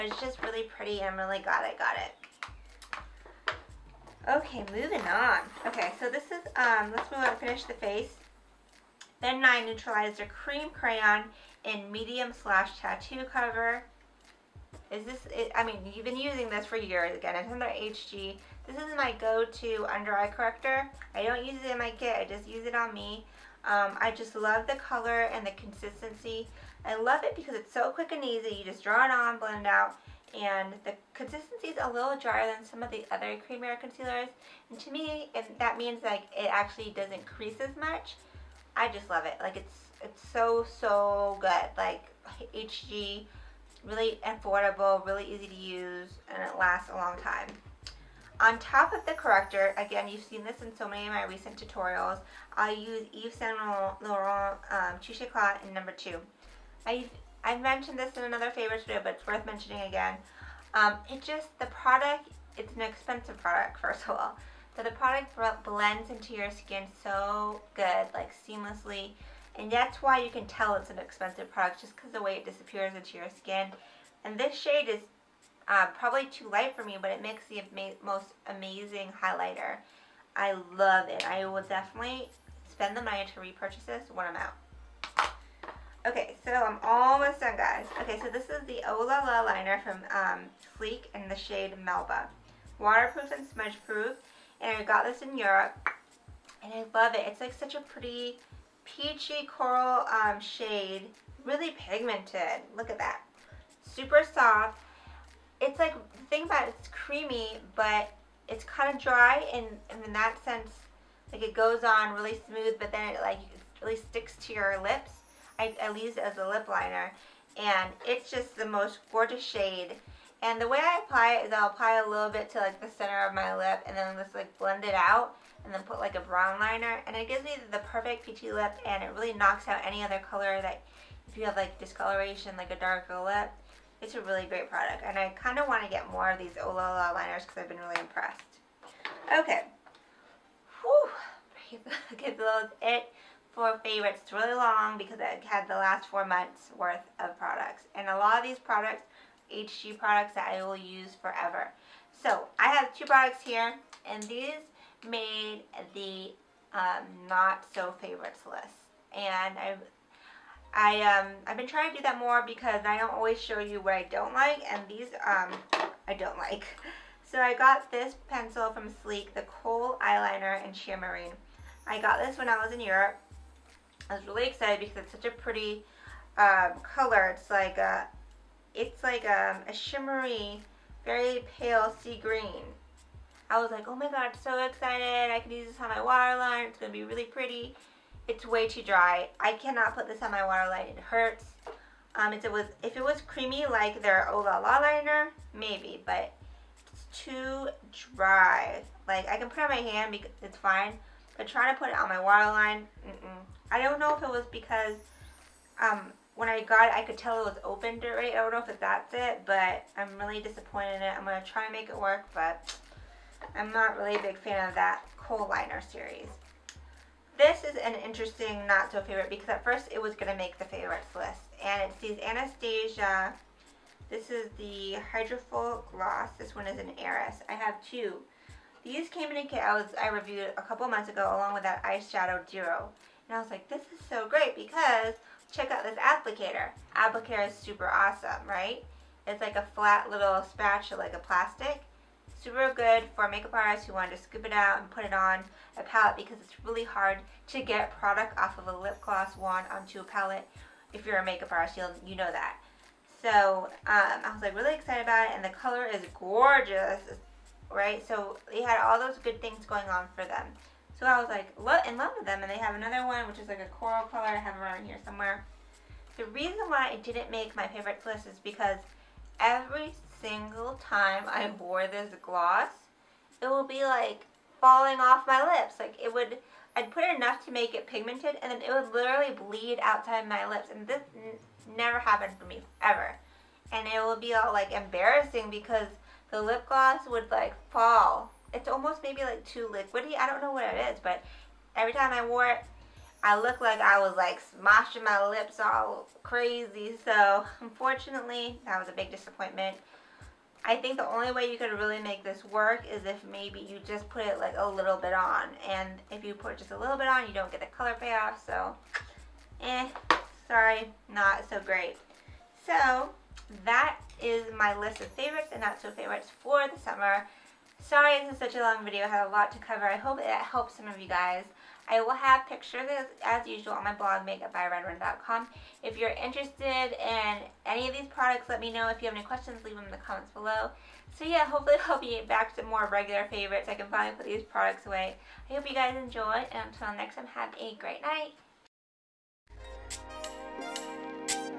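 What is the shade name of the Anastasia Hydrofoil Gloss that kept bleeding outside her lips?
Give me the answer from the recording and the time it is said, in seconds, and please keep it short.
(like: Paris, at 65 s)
Eris, at 227 s.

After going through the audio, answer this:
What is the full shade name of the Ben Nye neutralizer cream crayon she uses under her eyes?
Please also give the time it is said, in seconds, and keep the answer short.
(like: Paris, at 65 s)
tattoo cover, at 12 s.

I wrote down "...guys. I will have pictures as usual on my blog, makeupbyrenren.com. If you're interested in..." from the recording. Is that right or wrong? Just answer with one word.
right.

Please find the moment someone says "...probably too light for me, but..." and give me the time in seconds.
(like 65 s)
75 s.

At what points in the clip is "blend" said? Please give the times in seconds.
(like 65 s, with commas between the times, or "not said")
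29 s, 65 s, 124 s.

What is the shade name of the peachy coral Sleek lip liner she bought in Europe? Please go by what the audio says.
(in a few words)
Melba.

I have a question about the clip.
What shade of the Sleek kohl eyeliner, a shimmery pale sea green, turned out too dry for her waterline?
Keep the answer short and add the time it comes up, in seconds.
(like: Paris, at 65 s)
Sheer Marine, at 170 s.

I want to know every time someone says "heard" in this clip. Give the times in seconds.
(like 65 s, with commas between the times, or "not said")
not said.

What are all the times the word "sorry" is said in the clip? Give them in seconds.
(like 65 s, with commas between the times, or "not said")
310 s, 317 s.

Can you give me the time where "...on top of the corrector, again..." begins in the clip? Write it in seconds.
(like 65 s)
48 s.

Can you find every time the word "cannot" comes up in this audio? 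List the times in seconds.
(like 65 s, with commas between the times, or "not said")
189 s.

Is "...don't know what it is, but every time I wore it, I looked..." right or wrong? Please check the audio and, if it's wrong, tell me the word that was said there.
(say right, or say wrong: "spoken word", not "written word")
right.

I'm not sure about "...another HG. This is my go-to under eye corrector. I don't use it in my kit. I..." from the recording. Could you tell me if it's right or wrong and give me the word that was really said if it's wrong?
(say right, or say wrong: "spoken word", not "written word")
right.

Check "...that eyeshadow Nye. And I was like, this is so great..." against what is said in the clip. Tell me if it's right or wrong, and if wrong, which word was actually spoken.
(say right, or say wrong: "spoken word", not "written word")
wrong: "Duro", not "Nye".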